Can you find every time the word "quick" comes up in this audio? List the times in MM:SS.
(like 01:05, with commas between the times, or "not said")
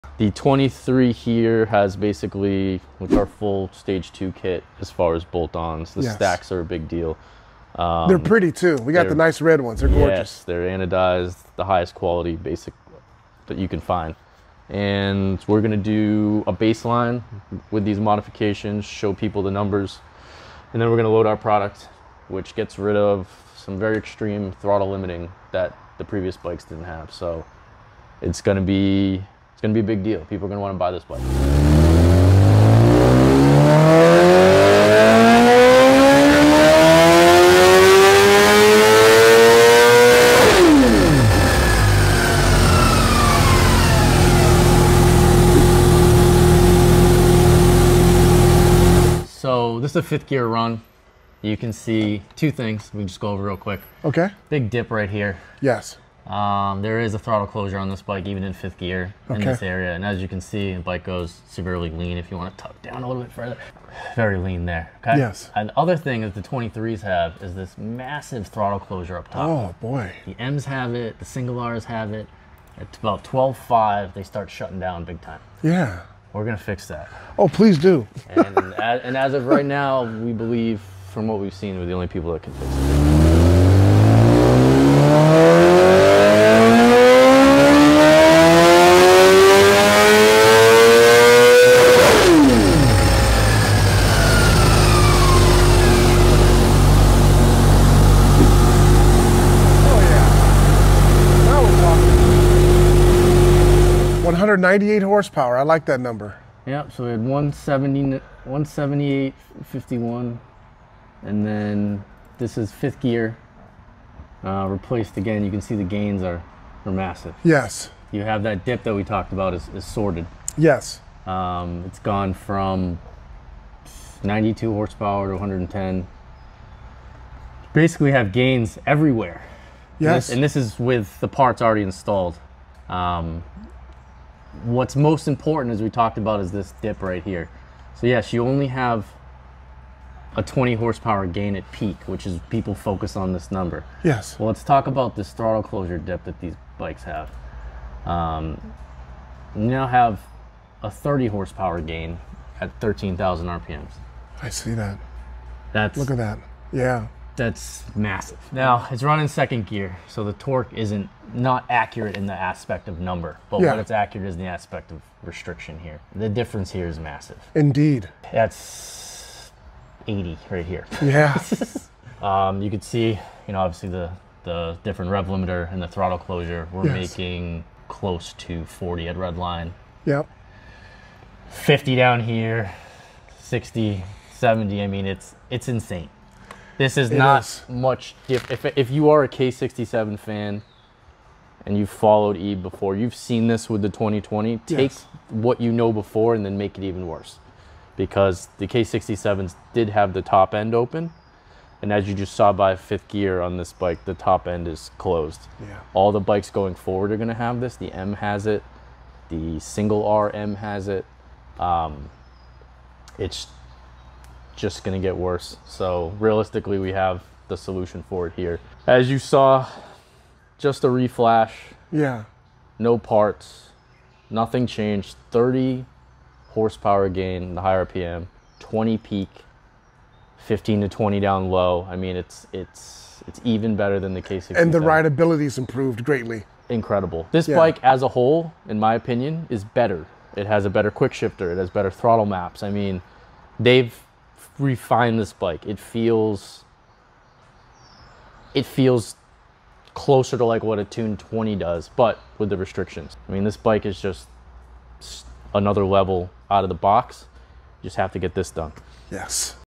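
00:53, 04:00.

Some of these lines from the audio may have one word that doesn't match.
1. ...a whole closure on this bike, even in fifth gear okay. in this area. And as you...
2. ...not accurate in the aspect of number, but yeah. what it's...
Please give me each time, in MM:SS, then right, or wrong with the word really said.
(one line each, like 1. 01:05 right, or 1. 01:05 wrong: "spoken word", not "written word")
1. 00:57 wrong: "throttle", not "whole"
2. 02:41 right.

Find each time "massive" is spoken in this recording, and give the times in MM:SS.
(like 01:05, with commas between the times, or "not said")
01:07, 01:56, 02:37, 02:46.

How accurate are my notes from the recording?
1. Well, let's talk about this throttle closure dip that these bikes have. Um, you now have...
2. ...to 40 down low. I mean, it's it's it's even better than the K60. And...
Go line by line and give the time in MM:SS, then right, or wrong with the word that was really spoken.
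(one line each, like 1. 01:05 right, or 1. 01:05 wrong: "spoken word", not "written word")
1. 02:24 right
2. 03:50 wrong: "20", not "40".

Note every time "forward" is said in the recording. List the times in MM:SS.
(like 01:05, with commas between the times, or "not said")
03:26.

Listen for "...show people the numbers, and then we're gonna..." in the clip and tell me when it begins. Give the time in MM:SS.
00:18.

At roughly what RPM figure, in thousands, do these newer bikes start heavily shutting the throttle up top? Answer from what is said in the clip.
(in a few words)
12.5.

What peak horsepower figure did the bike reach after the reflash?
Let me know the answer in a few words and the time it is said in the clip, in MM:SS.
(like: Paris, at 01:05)
198, at 01:44.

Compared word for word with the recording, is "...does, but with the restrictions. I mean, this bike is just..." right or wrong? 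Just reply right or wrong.
right.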